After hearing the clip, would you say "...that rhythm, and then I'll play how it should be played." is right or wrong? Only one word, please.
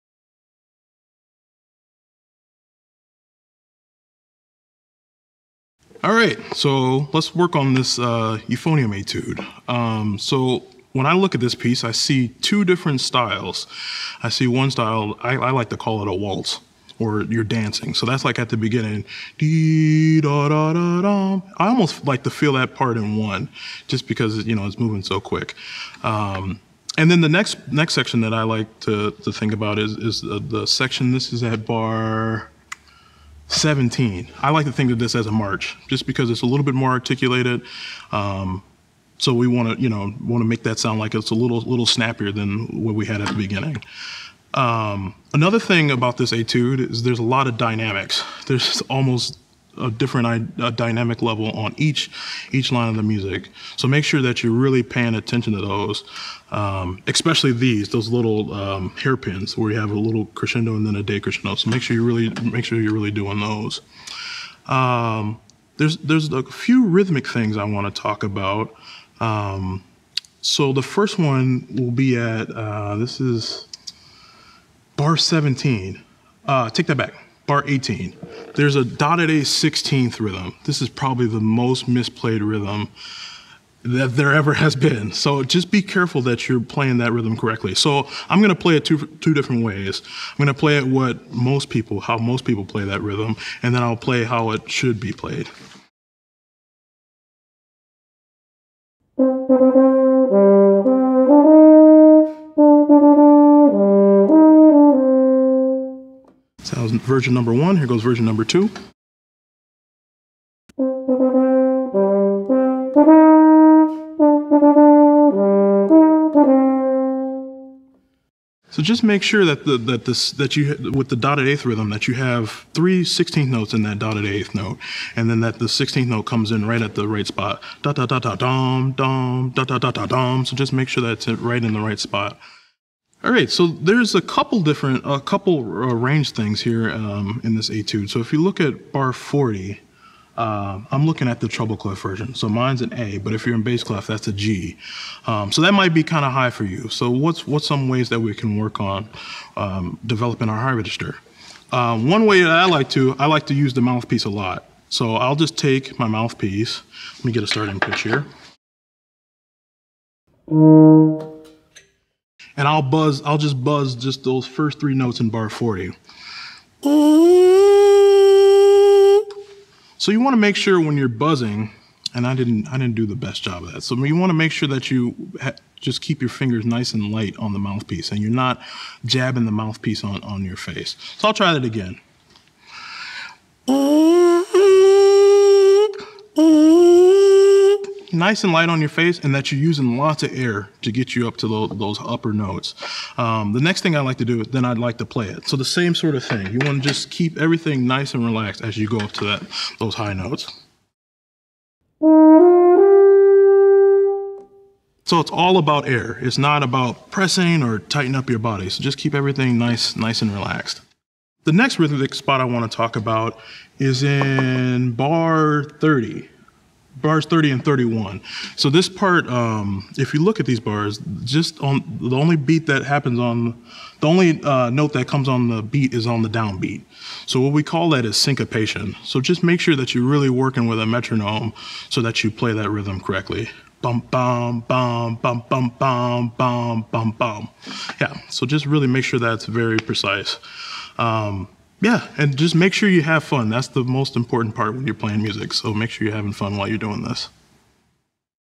right.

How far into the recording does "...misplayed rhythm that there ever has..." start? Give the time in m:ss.
1:21.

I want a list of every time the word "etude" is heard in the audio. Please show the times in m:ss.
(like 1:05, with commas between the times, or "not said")
0:08, 0:46, 2:17.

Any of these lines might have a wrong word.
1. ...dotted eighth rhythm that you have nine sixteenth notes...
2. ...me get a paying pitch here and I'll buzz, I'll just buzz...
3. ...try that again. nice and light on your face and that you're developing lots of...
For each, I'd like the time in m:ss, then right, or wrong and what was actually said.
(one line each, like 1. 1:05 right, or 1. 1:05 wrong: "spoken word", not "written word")
1. 2:01 wrong: "three", not "nine"
2. 2:37 wrong: "starting", not "paying"
3. 3:01 wrong: "using", not "developing".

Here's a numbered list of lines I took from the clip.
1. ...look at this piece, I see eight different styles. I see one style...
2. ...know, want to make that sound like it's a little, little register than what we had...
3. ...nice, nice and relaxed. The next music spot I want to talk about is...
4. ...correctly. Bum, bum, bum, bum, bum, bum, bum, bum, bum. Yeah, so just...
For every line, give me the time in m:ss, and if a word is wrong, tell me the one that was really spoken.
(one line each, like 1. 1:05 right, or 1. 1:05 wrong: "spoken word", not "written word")
1. 0:11 wrong: "two", not "eight"
2. 0:39 wrong: "snappier", not "register"
3. 3:29 wrong: "rhythmic", not "music"
4. 3:52 right.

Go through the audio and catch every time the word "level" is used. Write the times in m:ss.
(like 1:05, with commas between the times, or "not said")
0:51.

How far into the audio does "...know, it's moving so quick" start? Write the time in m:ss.
0:24.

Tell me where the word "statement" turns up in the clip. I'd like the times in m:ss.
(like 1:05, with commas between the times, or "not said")
not said.